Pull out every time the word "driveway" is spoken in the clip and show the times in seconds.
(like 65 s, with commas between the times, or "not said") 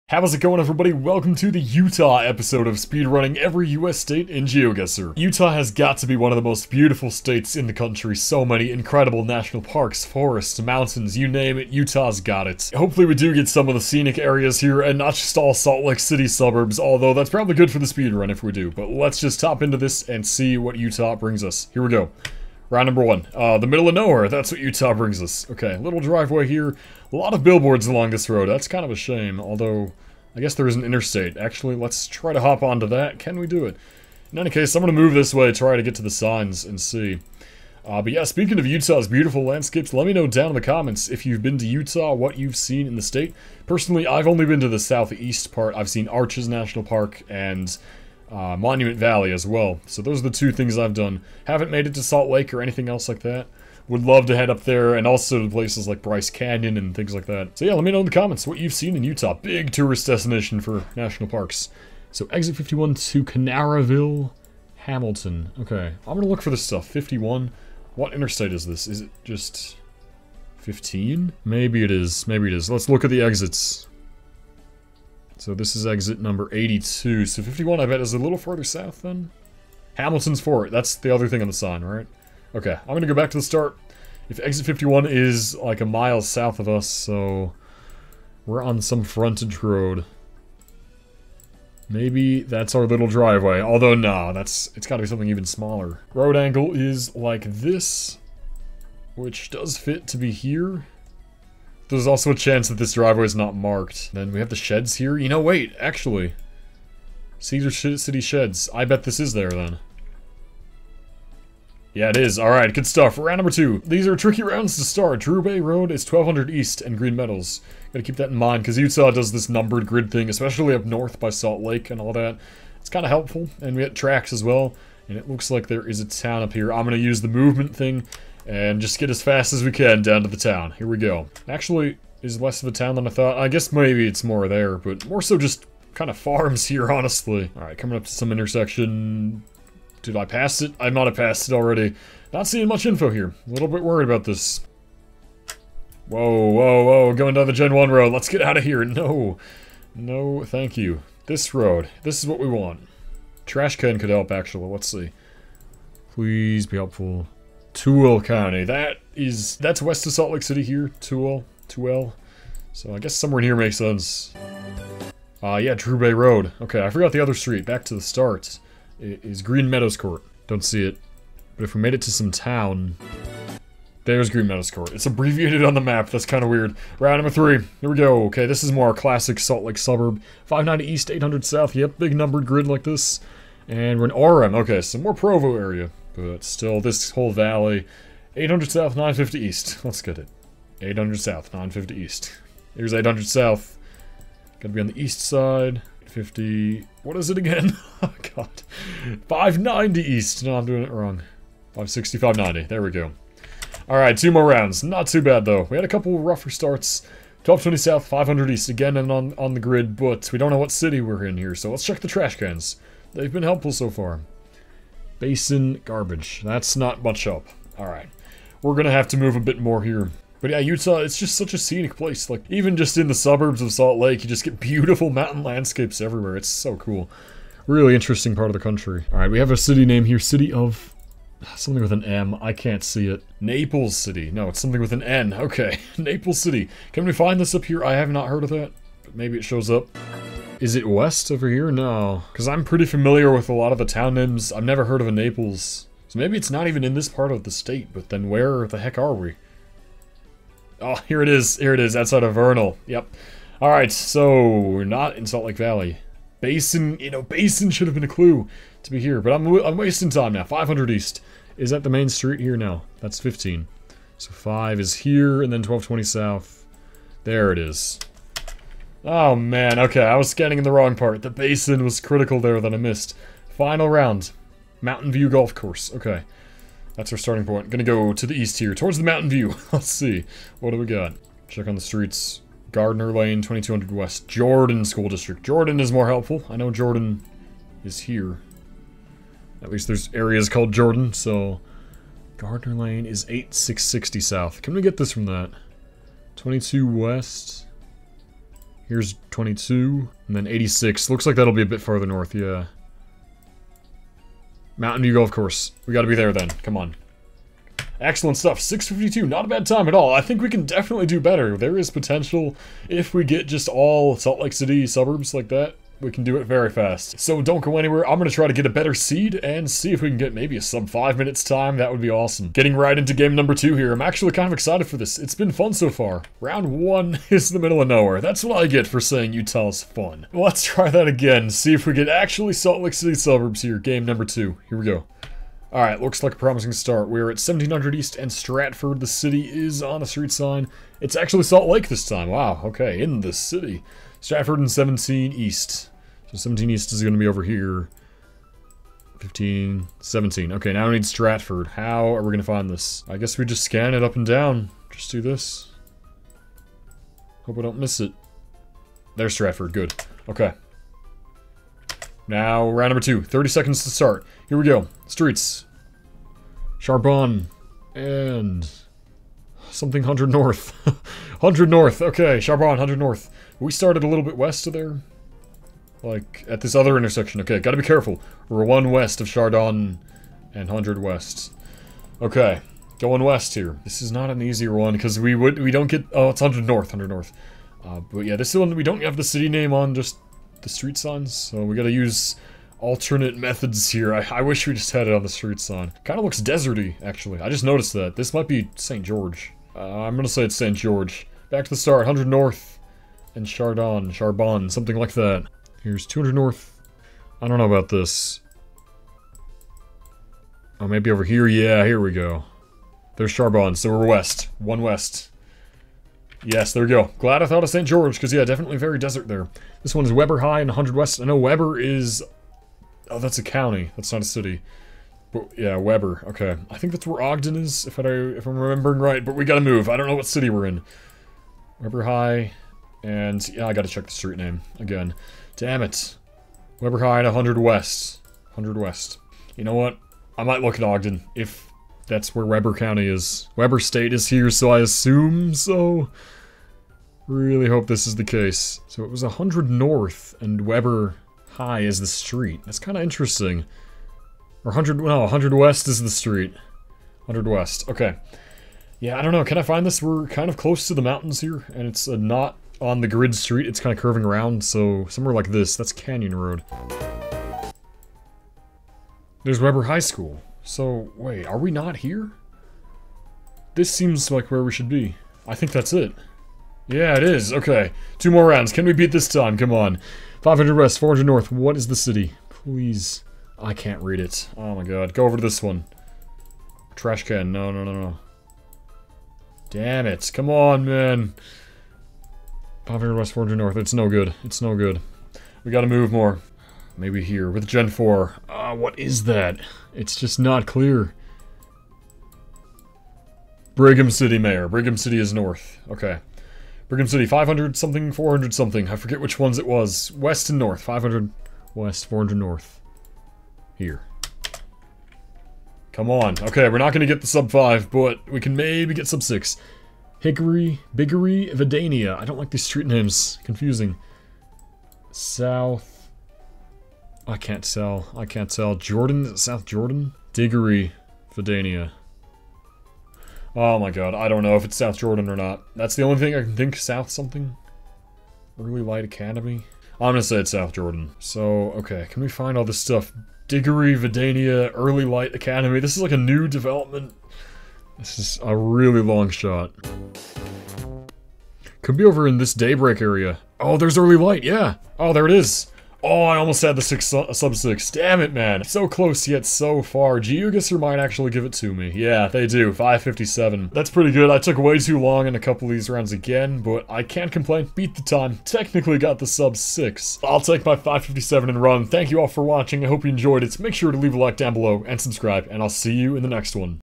25 s, 93 s, 102 s.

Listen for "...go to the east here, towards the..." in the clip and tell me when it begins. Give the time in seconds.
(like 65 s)
277 s.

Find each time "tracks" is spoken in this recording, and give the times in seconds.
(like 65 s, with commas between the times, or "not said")
123 s.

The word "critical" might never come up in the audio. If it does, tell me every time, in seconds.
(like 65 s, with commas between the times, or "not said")
271 s.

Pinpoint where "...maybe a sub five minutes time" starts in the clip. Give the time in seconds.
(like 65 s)
320 s.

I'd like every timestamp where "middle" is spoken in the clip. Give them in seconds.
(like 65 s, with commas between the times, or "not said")
23 s, 327 s.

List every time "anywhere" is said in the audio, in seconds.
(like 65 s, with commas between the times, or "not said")
317 s.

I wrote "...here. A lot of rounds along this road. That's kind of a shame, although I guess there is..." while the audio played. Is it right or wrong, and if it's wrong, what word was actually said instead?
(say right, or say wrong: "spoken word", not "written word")
wrong: "billboards", not "rounds".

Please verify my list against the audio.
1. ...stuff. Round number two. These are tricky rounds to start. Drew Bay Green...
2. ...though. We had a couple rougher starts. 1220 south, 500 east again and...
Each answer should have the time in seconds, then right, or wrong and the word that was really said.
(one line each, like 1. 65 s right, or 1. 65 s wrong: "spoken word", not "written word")
1. 112 s wrong: "Road", not "Green"
2. 205 s right.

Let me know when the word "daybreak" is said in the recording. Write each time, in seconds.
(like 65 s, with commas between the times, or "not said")
552 s.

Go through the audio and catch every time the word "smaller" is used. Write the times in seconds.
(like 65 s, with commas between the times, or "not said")
95 s.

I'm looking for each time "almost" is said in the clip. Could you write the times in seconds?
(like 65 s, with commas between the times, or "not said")
556 s.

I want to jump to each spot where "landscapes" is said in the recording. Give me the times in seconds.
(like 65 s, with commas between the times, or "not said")
39 s, 225 s.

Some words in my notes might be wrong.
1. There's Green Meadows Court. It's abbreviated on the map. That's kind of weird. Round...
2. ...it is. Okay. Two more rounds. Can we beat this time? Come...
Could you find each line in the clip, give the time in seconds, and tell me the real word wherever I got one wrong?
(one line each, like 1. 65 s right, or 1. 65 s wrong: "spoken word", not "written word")
1. 174 s right
2. 477 s right.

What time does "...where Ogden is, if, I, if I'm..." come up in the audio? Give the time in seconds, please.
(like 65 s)
427 s.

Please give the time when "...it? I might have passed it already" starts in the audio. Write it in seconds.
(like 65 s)
140 s.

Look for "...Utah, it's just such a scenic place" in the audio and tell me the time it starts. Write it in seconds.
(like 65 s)
220 s.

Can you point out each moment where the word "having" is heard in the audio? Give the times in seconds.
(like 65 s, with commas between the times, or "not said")
not said.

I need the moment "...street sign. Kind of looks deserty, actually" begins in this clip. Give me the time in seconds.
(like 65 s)
395 s.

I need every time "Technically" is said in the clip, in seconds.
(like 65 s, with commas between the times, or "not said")
568 s.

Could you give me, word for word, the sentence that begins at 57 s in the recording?
So yeah, let me know in the comments what you've seen in Utah.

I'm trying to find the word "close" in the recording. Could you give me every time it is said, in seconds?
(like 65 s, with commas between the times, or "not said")
460 s, 558 s.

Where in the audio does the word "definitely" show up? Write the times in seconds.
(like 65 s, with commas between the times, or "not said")
310 s, 418 s.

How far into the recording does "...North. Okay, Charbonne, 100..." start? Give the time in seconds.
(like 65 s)
371 s.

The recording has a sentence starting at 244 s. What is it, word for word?
I've never heard of a Naples.